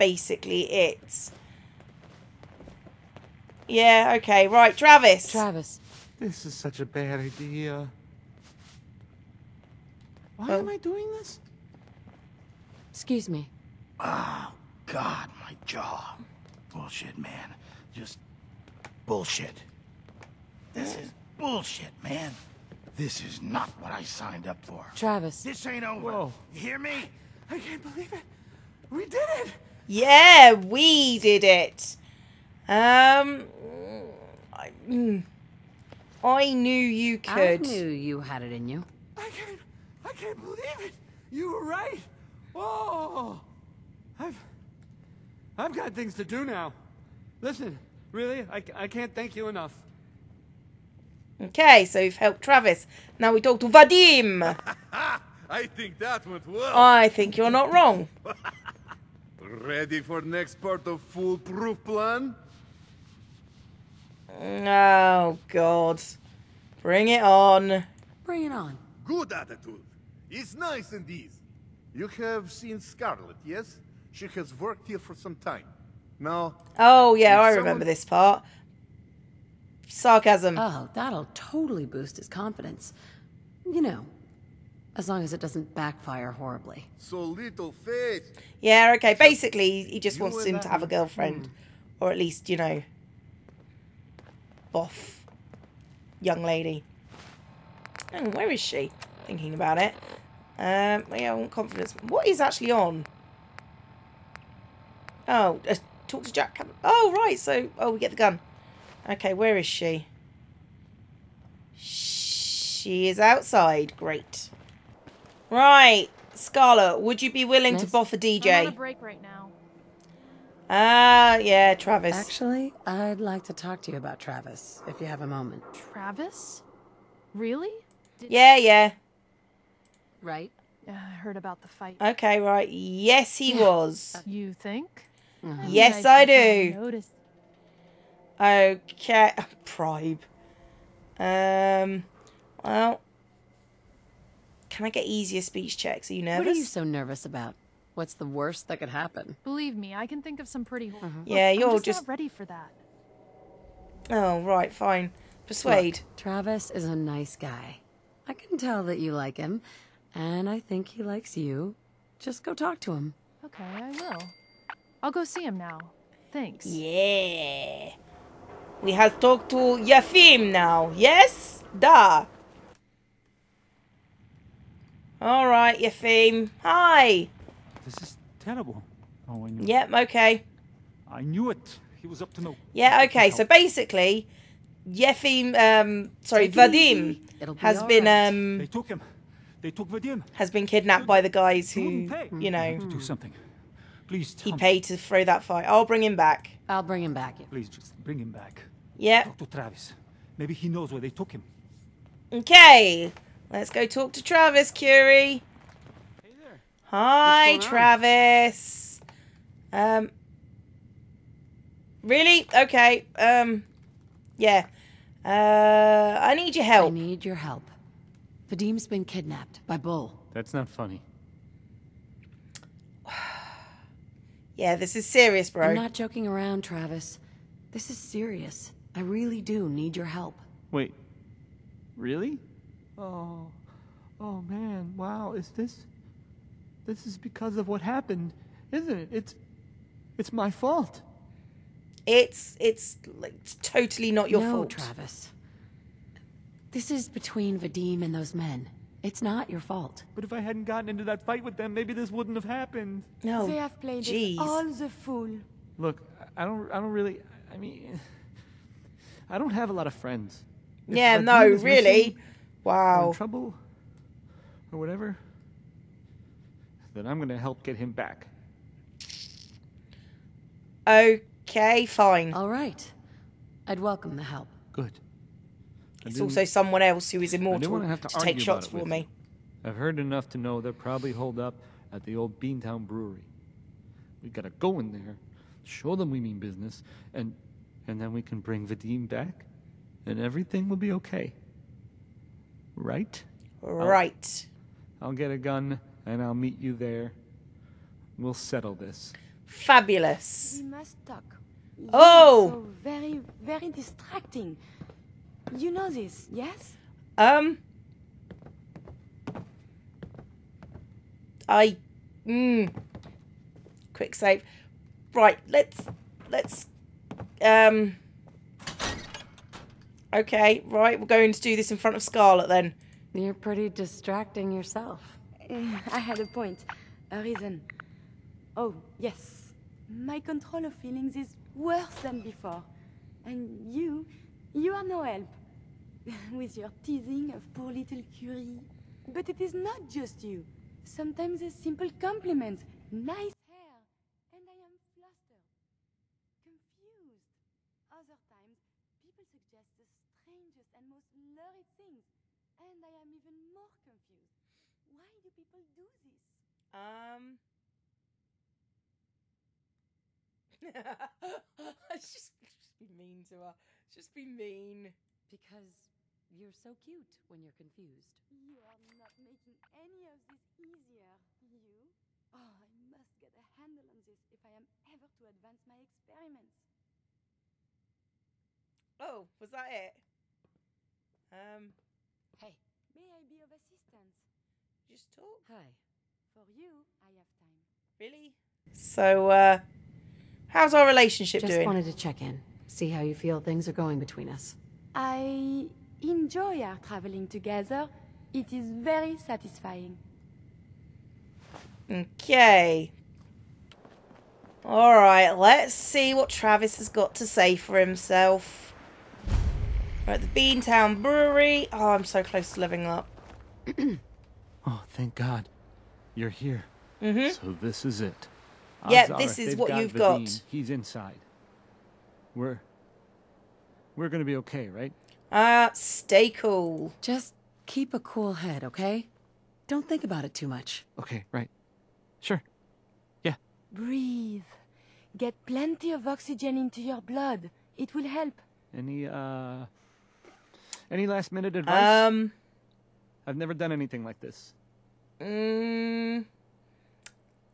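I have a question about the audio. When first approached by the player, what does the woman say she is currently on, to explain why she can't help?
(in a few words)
A break.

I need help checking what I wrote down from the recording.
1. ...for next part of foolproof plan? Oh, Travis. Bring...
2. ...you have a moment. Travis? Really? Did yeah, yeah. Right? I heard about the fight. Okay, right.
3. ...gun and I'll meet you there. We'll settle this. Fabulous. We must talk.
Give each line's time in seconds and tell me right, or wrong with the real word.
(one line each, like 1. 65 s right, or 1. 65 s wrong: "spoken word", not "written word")
1. 60 s wrong: "God", not "Travis"
2. 124 s right
3. 295 s right.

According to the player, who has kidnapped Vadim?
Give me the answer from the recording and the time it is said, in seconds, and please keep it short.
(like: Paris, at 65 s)
Bull, at 219 s.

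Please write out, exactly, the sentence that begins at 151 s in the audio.
Yeah, Look, you're just, just, not ready for that.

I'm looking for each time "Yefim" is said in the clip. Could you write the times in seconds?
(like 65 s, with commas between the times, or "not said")
169 s, 175 s, 184 s.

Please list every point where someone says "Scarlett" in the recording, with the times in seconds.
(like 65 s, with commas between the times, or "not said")
72 s, 116 s, 322 s.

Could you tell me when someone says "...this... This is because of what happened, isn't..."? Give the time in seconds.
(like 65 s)
235 s.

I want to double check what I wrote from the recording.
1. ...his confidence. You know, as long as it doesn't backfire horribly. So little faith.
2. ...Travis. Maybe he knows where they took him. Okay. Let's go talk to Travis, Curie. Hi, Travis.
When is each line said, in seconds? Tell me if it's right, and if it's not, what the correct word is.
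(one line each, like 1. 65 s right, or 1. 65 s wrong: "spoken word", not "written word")
1. 82 s right
2. 199 s right.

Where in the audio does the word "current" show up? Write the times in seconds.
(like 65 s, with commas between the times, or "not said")
not said.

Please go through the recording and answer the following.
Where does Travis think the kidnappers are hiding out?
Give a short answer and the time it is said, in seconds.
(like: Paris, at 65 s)
The old Beantown Brewery, at 282 s.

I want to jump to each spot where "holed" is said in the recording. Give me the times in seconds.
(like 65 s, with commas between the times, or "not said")
281 s.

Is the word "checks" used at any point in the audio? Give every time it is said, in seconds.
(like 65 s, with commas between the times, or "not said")
145 s, 391 s.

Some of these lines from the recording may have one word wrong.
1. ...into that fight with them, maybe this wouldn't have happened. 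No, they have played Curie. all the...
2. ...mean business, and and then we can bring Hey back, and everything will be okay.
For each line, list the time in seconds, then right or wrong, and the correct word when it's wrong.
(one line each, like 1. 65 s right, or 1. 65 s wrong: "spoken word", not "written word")
1. 250 s wrong: "Jeez", not "Curie"
2. 286 s wrong: "Vadim", not "Hey".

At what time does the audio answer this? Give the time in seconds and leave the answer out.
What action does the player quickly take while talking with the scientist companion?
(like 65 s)
313 s.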